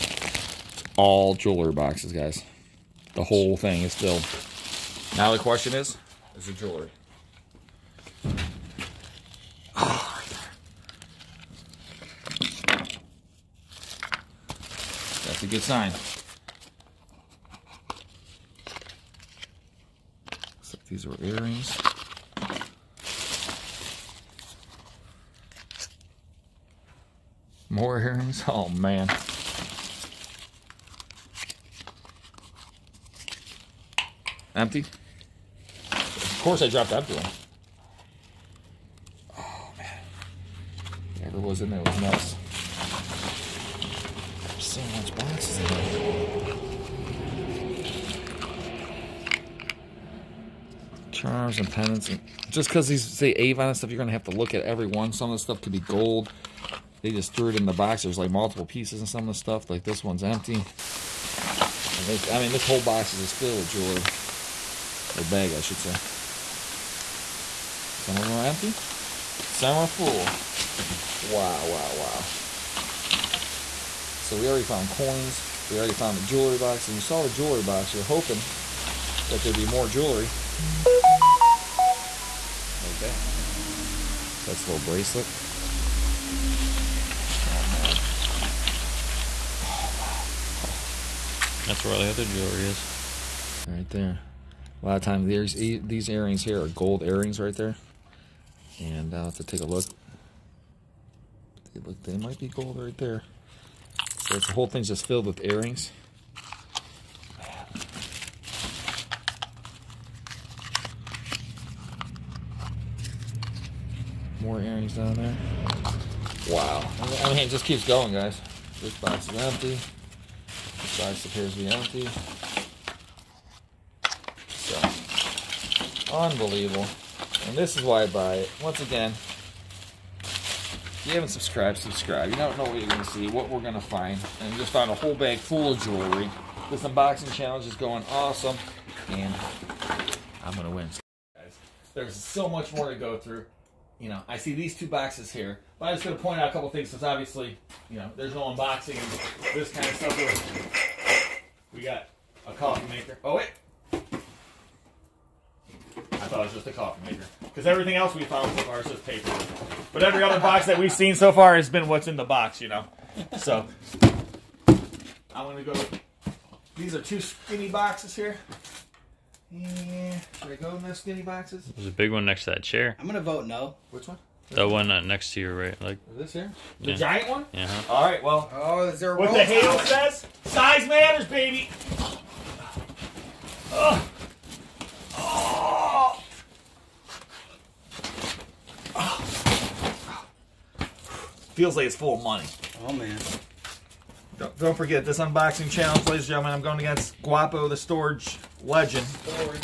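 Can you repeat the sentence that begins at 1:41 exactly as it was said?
They look, they might be gold right there the whole thing's just filled with earrings.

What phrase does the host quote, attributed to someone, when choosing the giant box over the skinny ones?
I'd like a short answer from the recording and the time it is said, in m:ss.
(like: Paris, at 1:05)
Size matters, baby, at 3:00.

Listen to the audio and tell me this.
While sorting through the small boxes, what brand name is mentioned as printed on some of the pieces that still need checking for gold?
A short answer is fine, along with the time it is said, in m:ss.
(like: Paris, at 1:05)
Avon, at 0:53.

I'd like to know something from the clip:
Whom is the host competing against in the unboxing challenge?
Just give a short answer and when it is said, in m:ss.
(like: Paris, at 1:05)
Guapo, at 3:17.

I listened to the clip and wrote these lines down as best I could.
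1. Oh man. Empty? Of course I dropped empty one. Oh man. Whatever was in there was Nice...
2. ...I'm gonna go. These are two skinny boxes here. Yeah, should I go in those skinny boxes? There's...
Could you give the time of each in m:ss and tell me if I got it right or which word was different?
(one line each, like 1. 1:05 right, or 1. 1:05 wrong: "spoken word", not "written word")
1. 0:28 right
2. 2:45 right.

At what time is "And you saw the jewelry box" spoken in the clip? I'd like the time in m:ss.
1:16.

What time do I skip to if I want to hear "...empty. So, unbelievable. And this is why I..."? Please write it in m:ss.
2:01.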